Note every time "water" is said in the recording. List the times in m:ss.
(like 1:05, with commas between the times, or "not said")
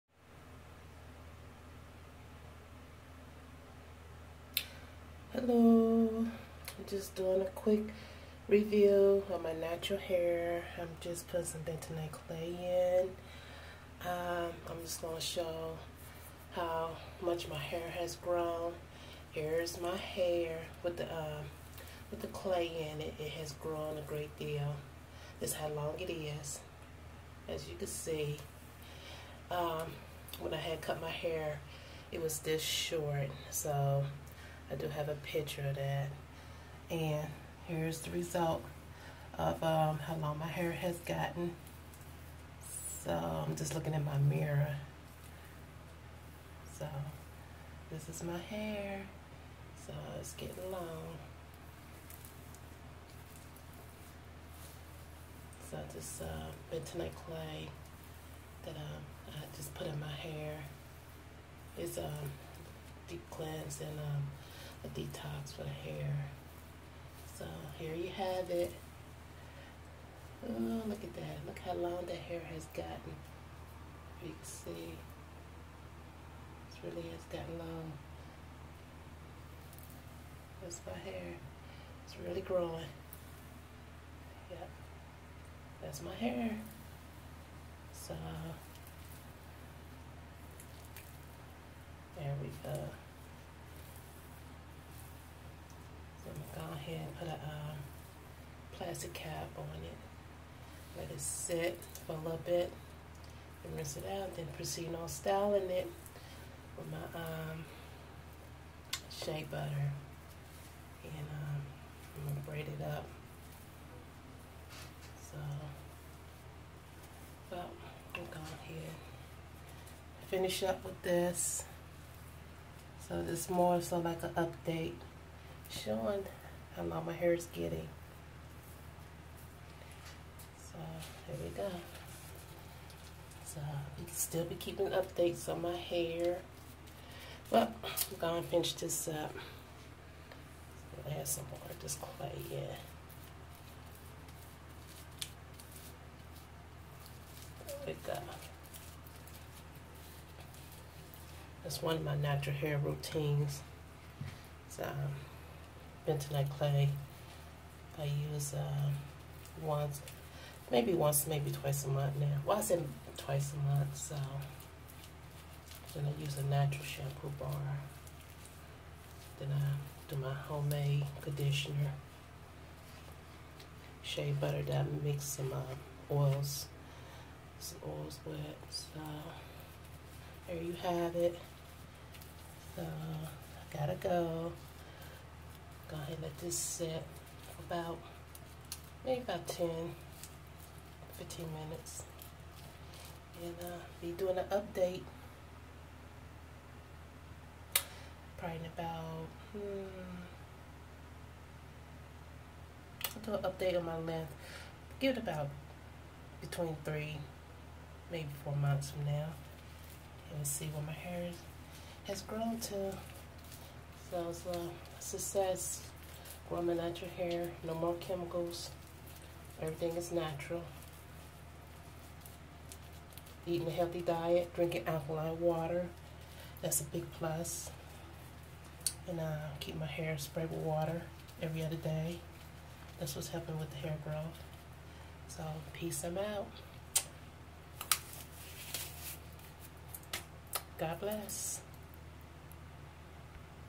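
3:45, 3:50.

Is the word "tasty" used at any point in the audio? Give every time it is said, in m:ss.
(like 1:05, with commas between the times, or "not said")
not said.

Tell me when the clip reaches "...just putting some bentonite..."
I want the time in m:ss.
0:10.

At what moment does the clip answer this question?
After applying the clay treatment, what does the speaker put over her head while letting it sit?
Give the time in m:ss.
1:38.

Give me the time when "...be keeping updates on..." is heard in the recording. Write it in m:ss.
2:14.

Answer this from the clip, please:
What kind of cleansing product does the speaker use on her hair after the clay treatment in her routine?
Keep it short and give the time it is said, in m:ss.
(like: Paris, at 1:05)
natural shampoo bar, at 2:46.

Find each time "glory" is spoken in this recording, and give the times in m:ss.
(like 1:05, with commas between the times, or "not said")
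not said.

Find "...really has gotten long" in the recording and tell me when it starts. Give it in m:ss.
1:16.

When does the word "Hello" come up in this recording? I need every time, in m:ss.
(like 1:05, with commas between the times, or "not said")
0:05.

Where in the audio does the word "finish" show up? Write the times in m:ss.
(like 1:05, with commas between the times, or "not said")
2:00, 2:18.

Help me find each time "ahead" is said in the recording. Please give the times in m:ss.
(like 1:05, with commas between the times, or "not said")
1:36, 1:58, 3:05.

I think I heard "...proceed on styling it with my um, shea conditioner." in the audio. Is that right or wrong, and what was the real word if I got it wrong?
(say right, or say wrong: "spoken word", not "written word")
wrong: "butter", not "conditioner".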